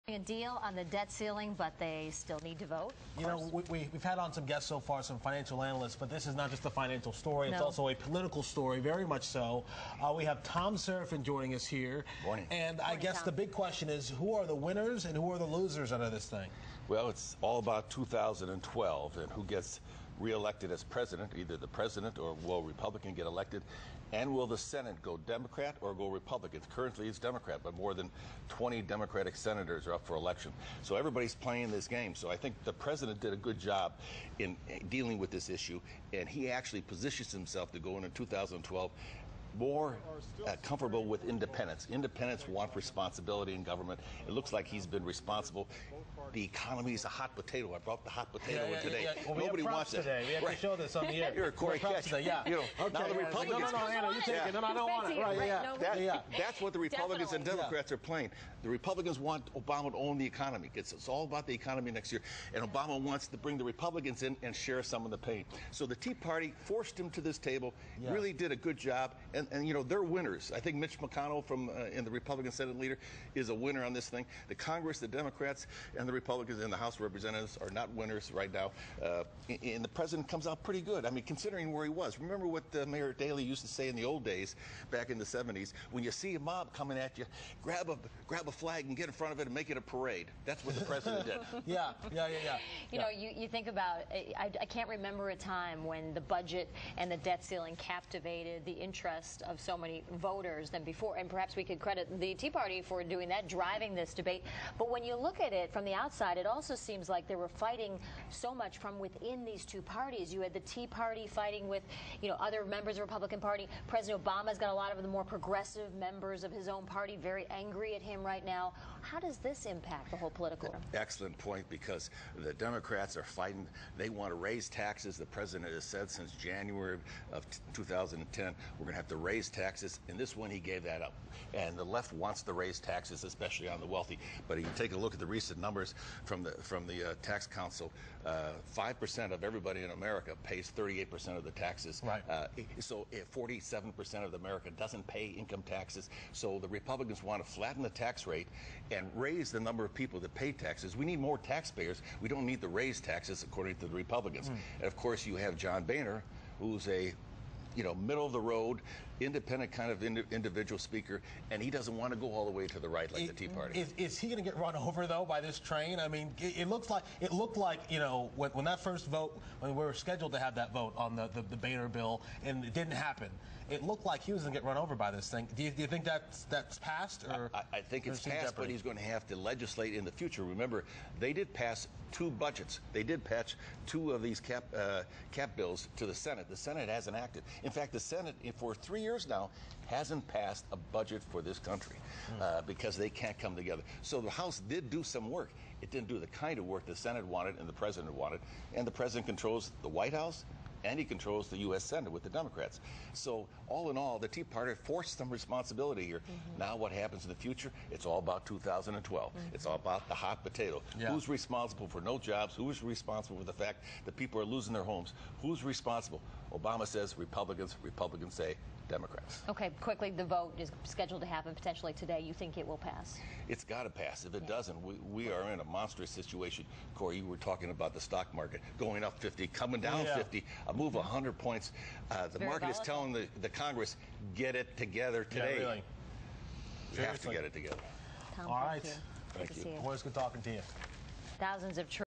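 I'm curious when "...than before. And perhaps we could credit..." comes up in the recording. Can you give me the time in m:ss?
1:40.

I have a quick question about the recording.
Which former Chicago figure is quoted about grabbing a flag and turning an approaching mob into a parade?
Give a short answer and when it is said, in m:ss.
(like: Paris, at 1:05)
Mayor Daley, at 1:22.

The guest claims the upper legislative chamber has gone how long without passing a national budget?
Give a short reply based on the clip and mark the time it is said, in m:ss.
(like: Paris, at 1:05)
3 years, at 3:08.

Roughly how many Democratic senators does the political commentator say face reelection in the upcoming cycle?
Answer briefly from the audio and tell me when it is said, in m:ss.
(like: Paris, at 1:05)
more than 20, at 0:27.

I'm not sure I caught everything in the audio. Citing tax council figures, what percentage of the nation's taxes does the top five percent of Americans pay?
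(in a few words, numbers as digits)
38 percent.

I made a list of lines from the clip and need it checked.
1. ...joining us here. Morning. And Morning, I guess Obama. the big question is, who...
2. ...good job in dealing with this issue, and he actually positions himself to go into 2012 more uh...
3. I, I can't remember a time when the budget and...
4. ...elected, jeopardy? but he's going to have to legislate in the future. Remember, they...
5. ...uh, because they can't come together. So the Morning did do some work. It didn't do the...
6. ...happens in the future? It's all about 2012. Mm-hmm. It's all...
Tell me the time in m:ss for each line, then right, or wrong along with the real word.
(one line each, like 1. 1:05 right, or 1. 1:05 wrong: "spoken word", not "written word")
1. 0:11 wrong: "Thom", not "Obama"
2. 0:33 right
3. 1:34 right
4. 2:58 wrong: "passed", not "elected"
5. 3:12 wrong: "House", not "Morning"
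6. 3:26 right.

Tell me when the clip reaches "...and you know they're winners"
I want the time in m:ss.
1:09.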